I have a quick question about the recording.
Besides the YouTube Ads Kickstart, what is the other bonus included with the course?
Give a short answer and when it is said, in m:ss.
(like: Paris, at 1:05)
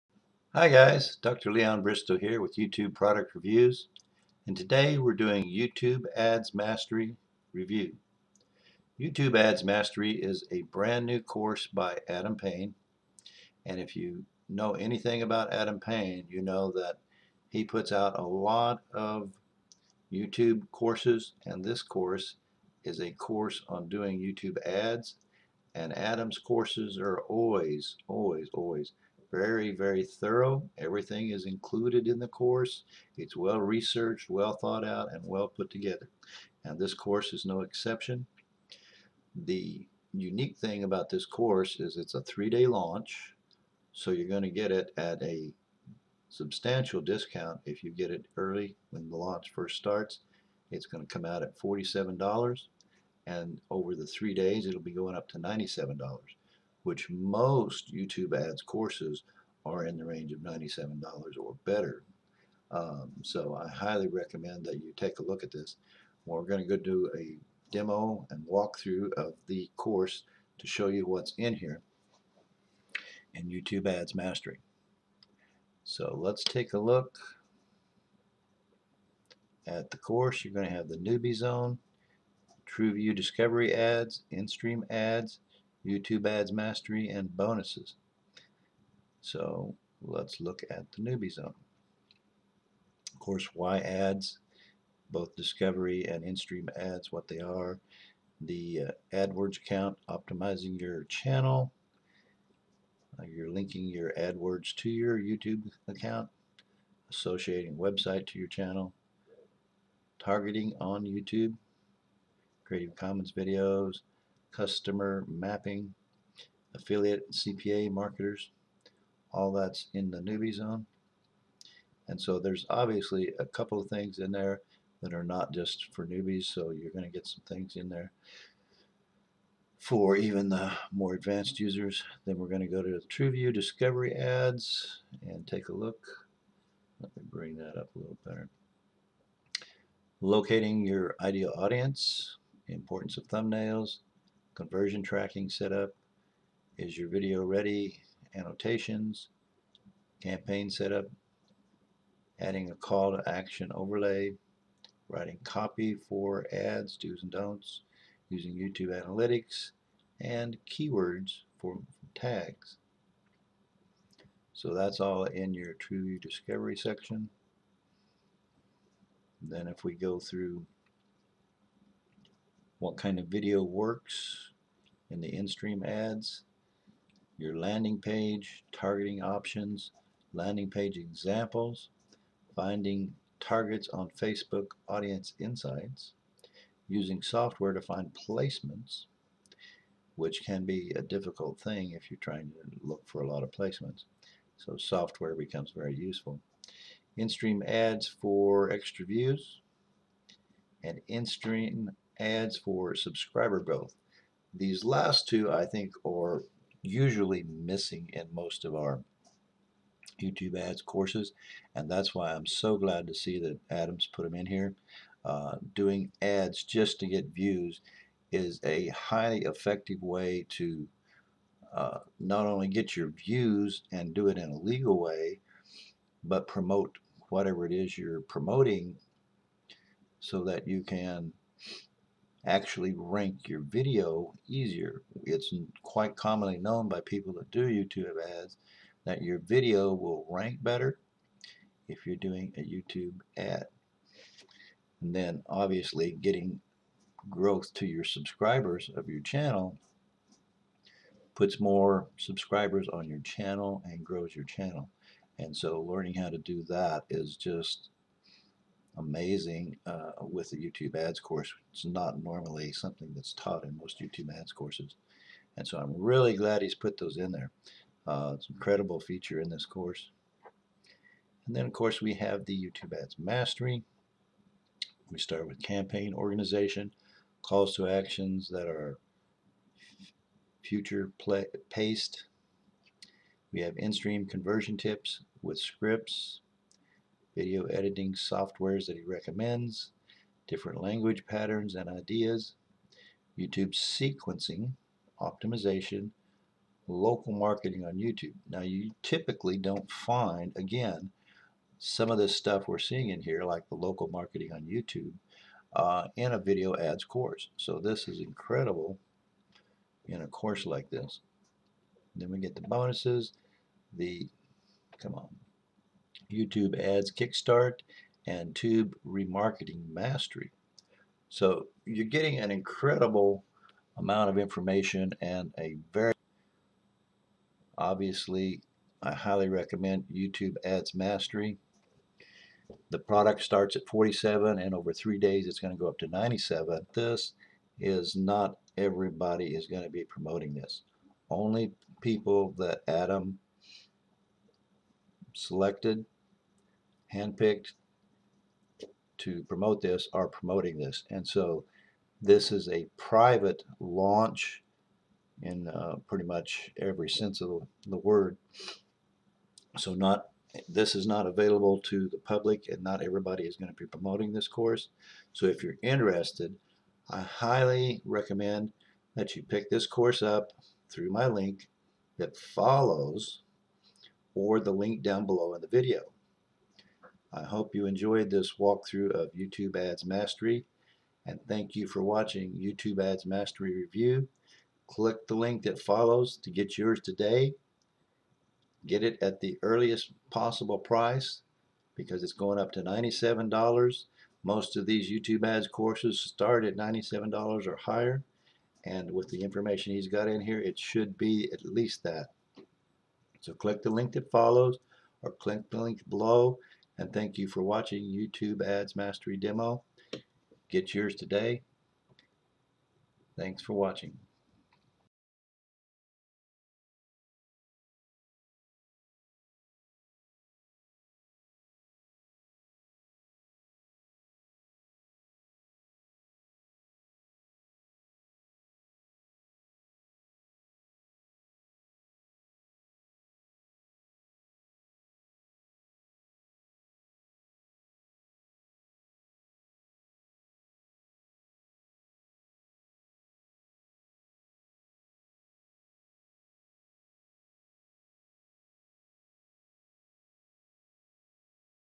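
Tube Remarketing Mastery, at 5:18.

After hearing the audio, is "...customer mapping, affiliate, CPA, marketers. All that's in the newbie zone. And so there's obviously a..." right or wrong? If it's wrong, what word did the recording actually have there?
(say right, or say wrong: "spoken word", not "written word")
right.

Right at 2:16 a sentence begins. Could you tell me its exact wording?
Let me bring that up a little better.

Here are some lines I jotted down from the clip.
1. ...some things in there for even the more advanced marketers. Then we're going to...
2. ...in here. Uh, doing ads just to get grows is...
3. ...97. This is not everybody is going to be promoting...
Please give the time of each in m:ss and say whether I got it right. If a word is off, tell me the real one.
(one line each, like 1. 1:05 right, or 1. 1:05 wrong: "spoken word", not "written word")
1. 2:07 wrong: "users", not "marketers"
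2. 3:34 wrong: "views", not "grows"
3. 5:36 right.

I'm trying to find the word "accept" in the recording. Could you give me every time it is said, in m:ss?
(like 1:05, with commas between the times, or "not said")
not said.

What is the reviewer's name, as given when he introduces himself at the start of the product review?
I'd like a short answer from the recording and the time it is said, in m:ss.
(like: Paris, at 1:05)
Leon Bristow, at 0:01.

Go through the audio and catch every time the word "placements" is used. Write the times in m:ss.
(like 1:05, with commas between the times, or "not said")
3:08, 3:13.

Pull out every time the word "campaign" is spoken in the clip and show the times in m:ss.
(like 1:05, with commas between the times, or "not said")
2:30, 4:35.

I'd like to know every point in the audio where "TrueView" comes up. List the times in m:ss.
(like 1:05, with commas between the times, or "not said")
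1:22, 2:13, 2:45.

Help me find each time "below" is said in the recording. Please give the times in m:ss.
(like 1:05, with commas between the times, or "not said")
6:15, 6:46.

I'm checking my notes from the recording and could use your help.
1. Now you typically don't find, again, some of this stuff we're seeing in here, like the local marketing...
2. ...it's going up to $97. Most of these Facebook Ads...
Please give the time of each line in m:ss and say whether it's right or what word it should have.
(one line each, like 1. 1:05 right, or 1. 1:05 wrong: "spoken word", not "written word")
1. 4:58 right
2. 6:32 wrong: "YouTube", not "Facebook".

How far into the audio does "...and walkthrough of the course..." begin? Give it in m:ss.
1:08.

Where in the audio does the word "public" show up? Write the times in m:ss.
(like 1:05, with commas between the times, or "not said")
6:02.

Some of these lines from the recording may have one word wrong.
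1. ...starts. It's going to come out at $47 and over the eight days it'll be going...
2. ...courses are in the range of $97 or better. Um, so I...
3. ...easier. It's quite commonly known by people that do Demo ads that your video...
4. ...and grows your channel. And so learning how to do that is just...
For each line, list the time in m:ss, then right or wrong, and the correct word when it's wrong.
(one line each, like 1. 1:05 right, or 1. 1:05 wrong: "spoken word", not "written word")
1. 0:49 wrong: "three", not "eight"
2. 0:58 right
3. 3:54 wrong: "YouTube", not "Demo"
4. 4:13 right.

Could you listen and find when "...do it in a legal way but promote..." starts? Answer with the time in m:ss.
3:44.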